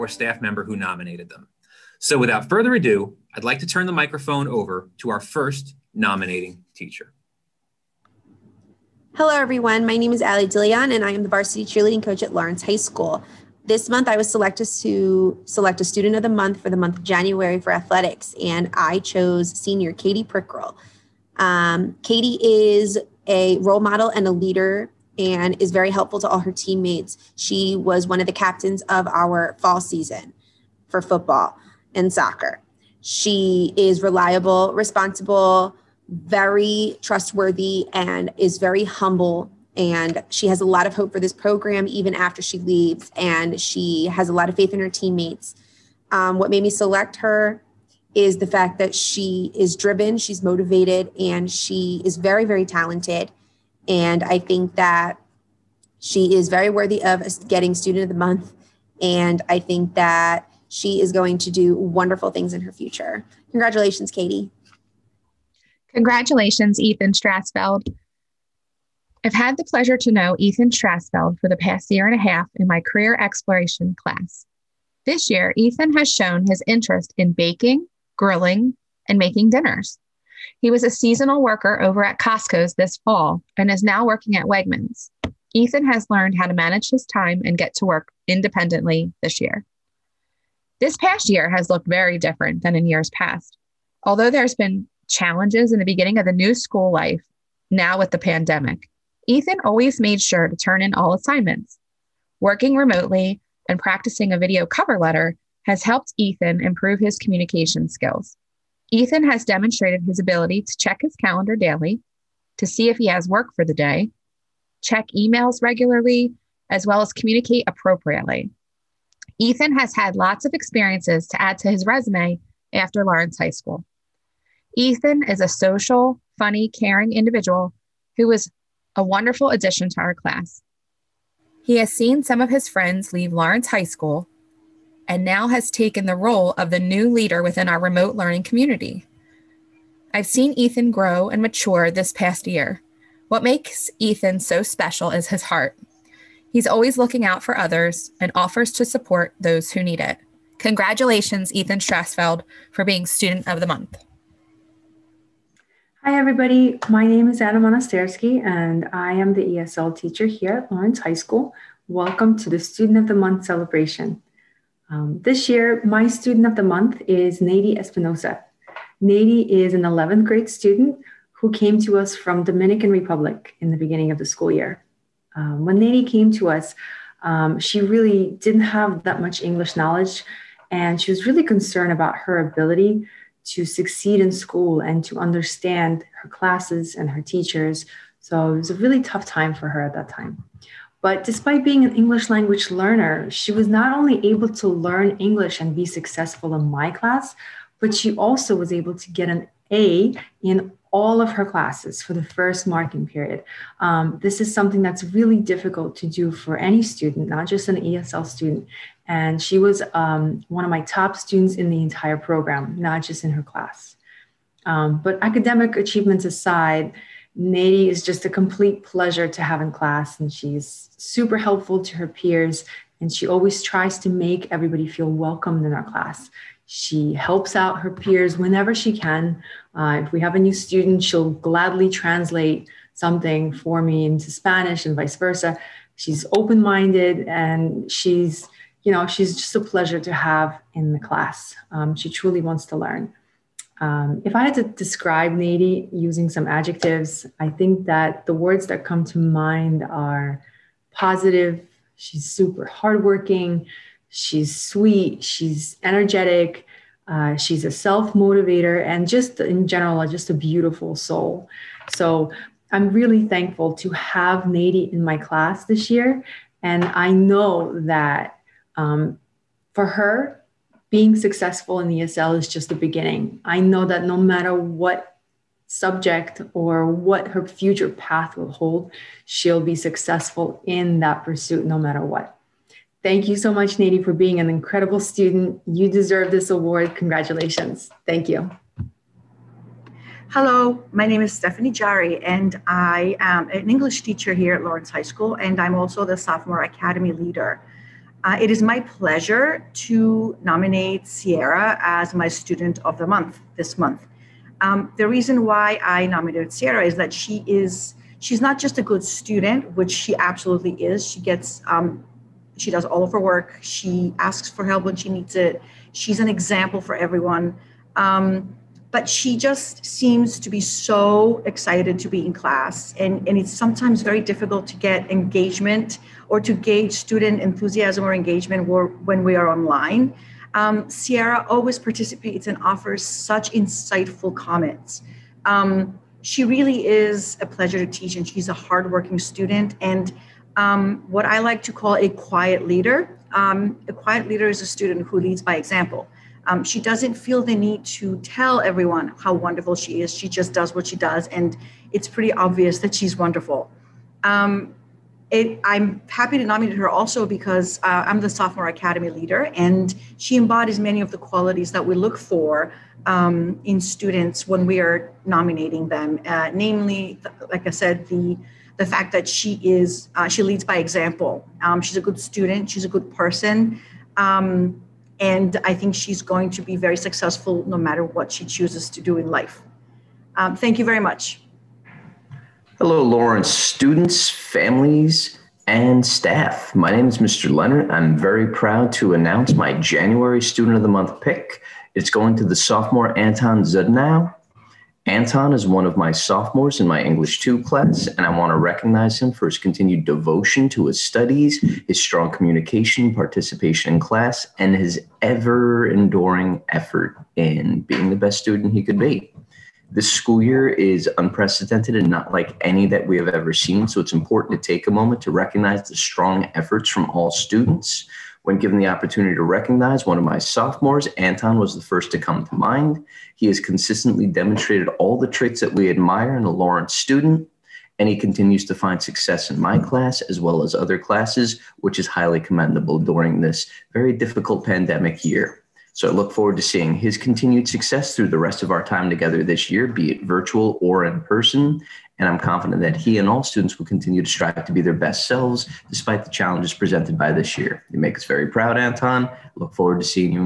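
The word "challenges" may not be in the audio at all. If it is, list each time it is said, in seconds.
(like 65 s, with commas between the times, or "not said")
95 s, 446 s.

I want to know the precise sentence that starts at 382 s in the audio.
Hello, Lawrence, students, families, and staff.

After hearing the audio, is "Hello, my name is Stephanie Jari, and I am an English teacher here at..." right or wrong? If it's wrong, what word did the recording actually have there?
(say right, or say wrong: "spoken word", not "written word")
right.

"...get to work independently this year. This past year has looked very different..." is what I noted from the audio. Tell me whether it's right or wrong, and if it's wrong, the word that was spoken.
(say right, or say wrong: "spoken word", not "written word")
right.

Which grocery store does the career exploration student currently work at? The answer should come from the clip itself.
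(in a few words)
Wegmans.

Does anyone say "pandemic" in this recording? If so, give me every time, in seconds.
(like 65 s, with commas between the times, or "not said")
98 s, 434 s.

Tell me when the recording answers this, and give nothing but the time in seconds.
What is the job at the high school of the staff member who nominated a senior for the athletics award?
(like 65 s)
11 s.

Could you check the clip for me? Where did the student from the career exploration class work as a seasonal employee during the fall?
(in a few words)
Costco.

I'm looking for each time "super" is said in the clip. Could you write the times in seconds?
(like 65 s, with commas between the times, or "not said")
220 s, 252 s.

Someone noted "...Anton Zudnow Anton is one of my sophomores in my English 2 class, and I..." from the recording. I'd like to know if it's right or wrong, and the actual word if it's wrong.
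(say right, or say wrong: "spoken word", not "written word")
right.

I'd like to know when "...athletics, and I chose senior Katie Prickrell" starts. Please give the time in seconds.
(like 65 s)
17 s.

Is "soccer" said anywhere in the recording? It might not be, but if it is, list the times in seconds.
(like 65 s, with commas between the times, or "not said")
32 s.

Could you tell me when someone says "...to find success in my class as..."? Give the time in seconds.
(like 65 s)
428 s.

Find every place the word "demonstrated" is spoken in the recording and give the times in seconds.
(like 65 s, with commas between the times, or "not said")
109 s, 424 s.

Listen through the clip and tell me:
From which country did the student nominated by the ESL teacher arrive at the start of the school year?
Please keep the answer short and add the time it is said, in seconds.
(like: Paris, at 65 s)
Dominican Republic, at 172 s.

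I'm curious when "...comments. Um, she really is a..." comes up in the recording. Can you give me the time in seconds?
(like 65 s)
334 s.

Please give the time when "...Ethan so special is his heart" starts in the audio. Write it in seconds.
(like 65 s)
143 s.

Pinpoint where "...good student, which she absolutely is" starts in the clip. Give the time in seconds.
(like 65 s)
308 s.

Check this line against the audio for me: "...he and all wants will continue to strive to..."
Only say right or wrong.
wrong.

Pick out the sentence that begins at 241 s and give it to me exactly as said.
Um, she truly wants to learn.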